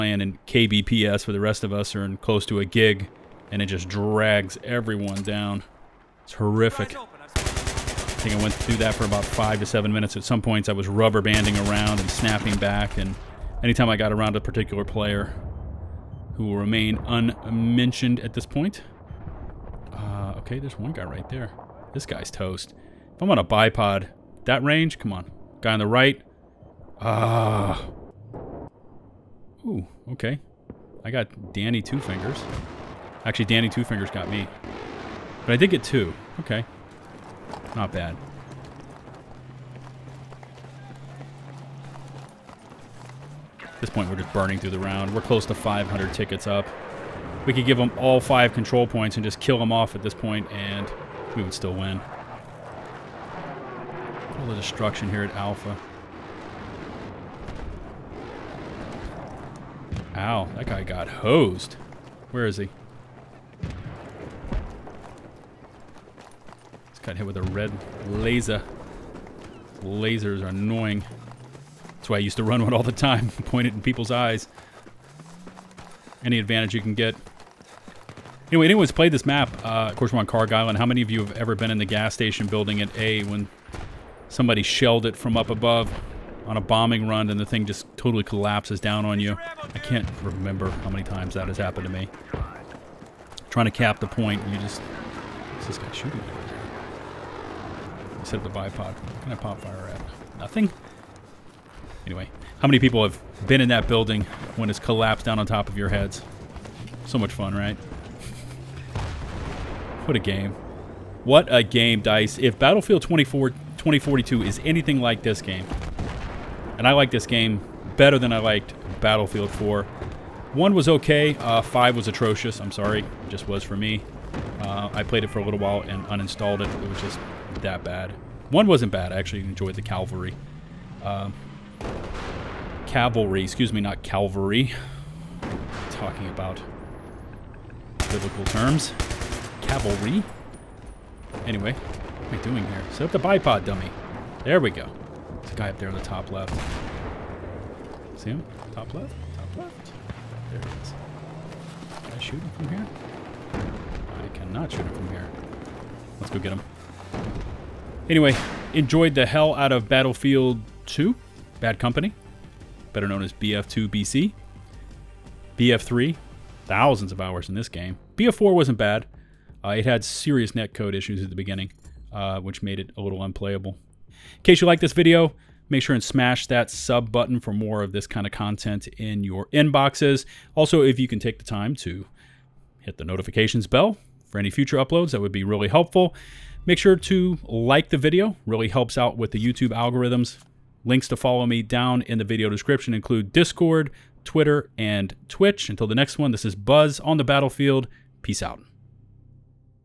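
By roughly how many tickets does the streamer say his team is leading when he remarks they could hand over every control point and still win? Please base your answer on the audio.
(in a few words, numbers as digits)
500.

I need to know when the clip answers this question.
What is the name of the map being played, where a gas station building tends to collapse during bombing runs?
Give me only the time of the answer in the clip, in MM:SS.
01:20.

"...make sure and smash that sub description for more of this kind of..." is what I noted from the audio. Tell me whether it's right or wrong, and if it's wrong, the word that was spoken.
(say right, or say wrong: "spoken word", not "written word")
wrong: "button", not "description".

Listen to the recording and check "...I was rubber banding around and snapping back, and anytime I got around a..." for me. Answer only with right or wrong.
right.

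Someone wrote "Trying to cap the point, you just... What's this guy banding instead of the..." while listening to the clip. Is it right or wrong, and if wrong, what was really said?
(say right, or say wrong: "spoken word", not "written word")
wrong: "shooting", not "banding".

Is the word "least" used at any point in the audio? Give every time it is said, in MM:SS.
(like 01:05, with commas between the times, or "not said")
not said.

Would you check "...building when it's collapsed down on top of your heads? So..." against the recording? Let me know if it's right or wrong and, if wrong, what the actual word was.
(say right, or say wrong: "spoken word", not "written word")
right.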